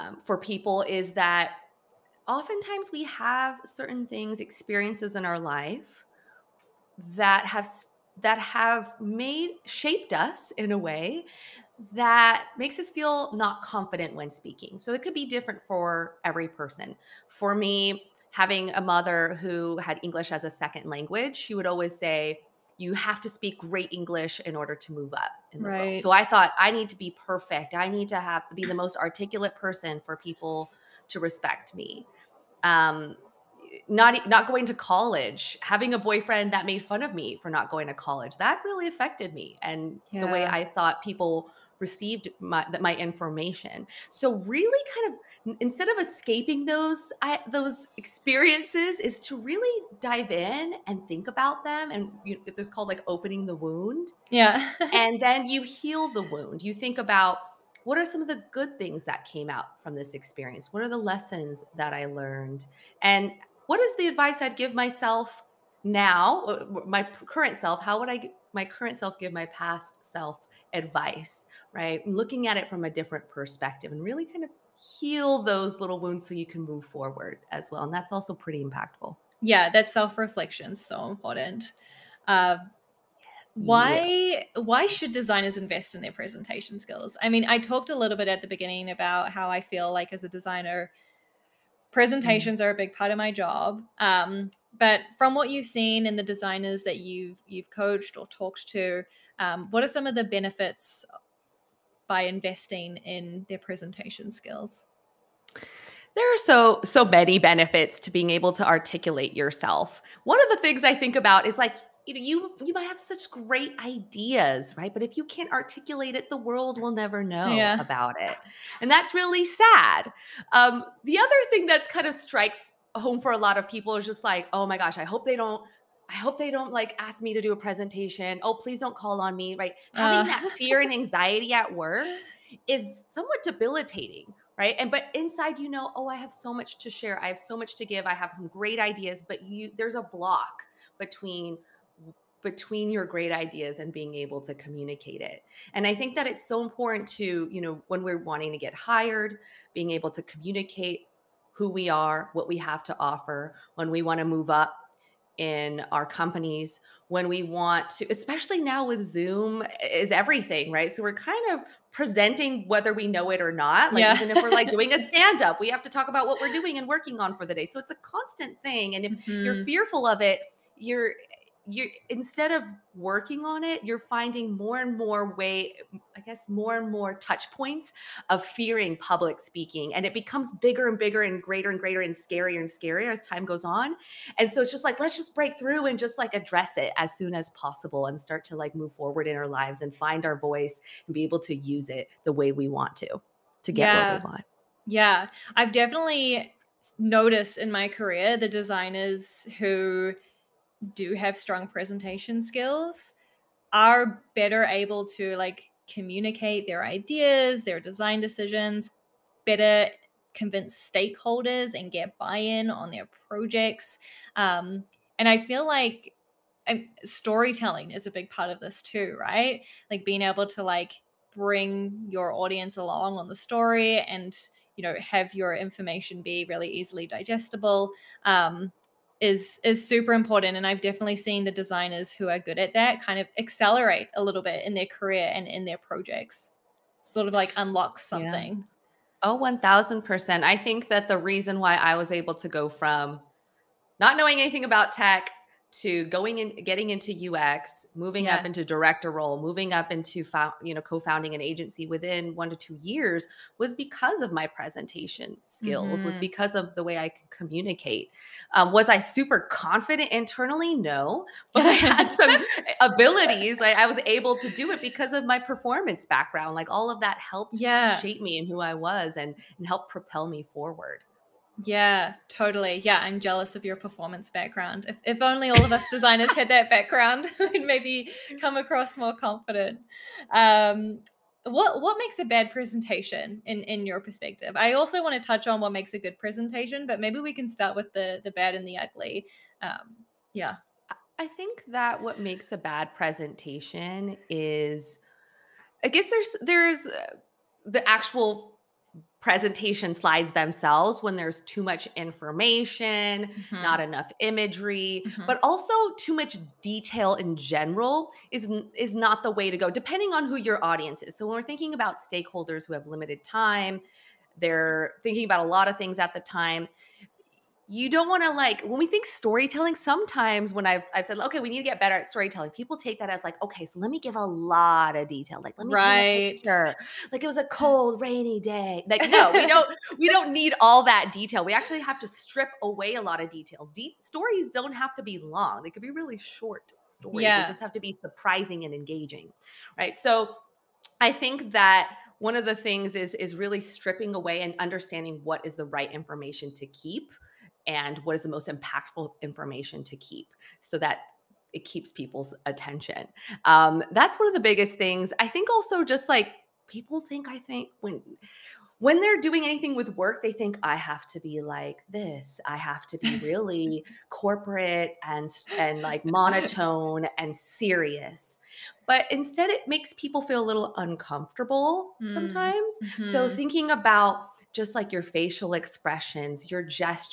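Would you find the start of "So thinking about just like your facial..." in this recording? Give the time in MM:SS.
06:13.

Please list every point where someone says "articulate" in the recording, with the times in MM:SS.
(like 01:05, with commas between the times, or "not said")
00:28, 01:48, 01:55.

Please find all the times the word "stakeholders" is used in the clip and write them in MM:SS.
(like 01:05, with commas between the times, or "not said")
03:30, 05:11.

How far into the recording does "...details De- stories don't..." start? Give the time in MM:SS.
05:33.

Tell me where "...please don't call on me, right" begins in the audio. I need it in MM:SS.
02:08.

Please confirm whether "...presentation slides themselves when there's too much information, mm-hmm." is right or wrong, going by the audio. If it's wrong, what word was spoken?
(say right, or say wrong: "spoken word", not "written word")
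right.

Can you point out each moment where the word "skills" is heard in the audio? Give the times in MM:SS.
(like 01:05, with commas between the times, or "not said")
01:26, 01:44, 03:22, 04:15.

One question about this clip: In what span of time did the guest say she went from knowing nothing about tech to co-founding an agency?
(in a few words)
1 to 2 years.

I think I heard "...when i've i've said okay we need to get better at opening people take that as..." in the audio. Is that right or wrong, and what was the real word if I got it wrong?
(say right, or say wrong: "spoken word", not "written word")
wrong: "storytelling", not "opening".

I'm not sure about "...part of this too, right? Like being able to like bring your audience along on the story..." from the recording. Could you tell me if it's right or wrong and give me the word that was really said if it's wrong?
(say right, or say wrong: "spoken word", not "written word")
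right.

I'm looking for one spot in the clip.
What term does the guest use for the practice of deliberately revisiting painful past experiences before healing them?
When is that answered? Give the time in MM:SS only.
00:53.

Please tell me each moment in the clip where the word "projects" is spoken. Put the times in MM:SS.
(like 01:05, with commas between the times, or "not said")
03:33, 03:55.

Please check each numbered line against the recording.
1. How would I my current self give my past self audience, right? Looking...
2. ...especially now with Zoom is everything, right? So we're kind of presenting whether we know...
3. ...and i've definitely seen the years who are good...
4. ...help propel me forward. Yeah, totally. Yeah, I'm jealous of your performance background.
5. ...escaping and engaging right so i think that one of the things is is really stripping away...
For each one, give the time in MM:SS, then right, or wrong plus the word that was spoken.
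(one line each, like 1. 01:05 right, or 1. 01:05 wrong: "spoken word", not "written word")
1. 01:07 wrong: "advice", not "audience"
2. 02:38 right
3. 03:50 wrong: "designers", not "years"
4. 04:29 right
5. 05:37 wrong: "surprising", not "escaping".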